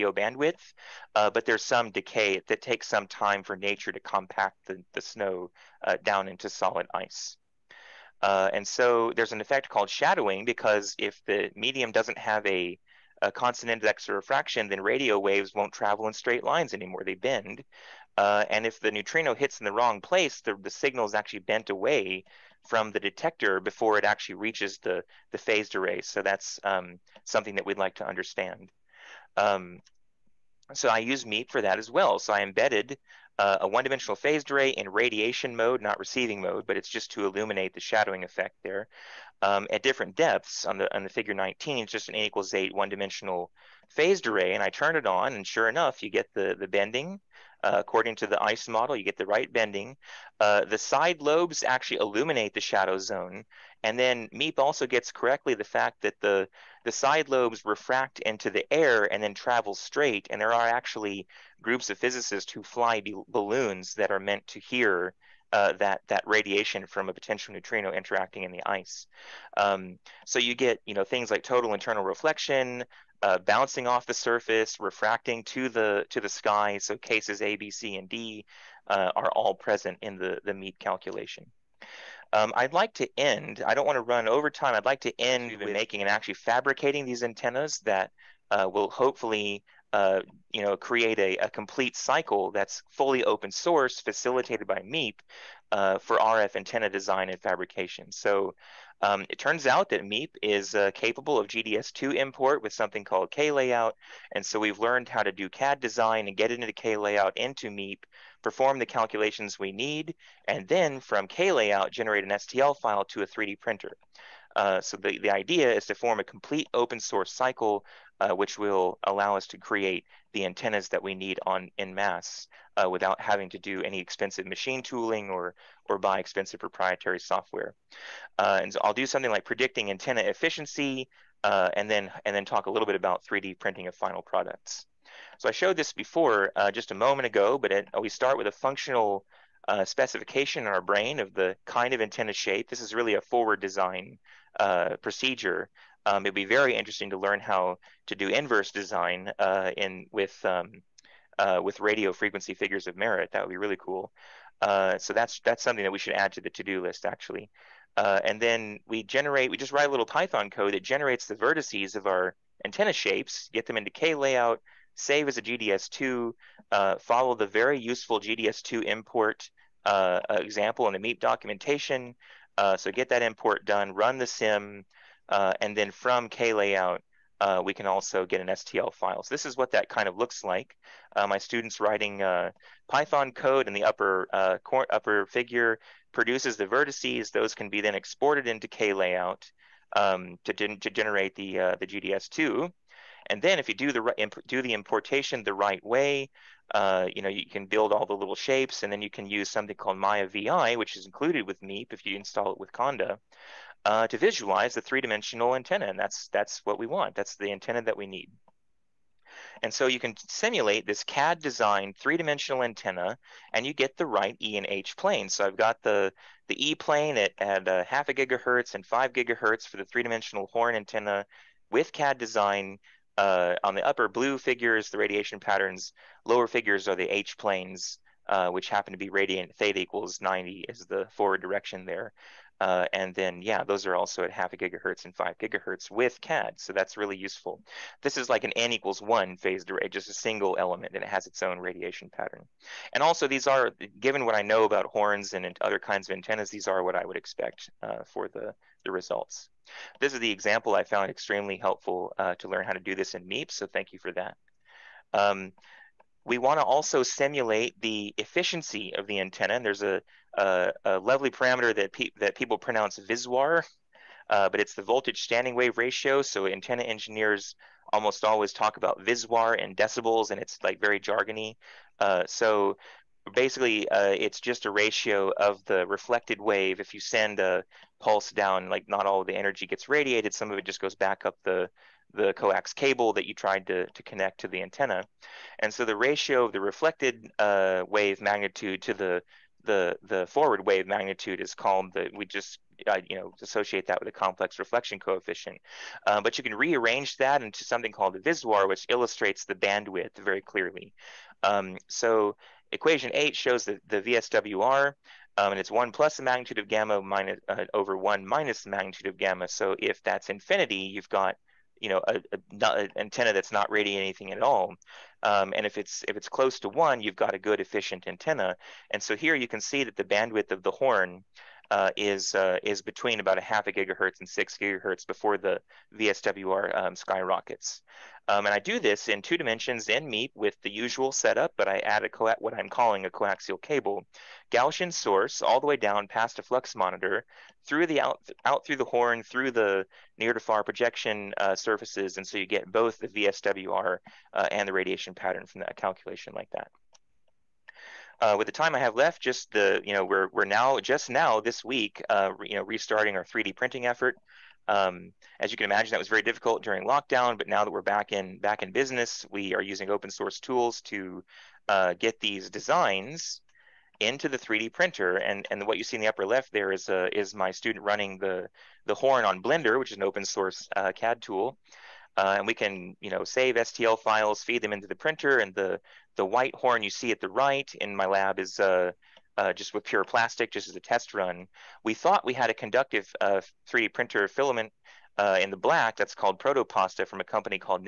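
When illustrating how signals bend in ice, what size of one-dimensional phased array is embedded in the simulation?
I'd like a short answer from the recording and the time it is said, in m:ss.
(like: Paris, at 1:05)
a equals 8, at 0:42.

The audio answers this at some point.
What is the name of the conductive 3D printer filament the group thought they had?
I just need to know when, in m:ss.
6:26.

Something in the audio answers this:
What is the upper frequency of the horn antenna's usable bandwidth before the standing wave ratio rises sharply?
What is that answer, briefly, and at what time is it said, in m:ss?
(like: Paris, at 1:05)
6 gigahertz, at 5:24.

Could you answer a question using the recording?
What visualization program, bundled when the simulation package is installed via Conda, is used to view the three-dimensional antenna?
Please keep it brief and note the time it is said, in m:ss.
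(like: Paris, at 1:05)
Mayavi, at 3:19.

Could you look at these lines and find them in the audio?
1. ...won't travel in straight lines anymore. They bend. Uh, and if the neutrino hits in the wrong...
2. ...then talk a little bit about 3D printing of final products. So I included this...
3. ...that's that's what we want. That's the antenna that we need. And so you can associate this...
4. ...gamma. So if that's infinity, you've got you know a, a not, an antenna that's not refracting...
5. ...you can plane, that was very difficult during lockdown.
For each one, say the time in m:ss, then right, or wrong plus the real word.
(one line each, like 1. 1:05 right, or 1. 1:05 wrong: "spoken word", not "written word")
1. 0:15 right
2. 2:12 wrong: "showed", not "included"
3. 3:25 wrong: "simulate", not "associate"
4. 5:09 wrong: "radiating", not "refracting"
5. 5:55 wrong: "imagine", not "plane".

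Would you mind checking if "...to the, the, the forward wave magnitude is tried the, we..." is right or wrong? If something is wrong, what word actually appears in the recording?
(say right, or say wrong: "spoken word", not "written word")
wrong: "called", not "tried".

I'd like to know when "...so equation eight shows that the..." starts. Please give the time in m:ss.
5:01.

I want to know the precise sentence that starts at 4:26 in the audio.
So antenna engineers almost always talk about VISWAR and decibels, and it's like very jargony.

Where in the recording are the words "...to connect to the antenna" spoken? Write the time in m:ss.
4:43.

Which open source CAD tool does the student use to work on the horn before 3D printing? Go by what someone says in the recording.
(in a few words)
Blender.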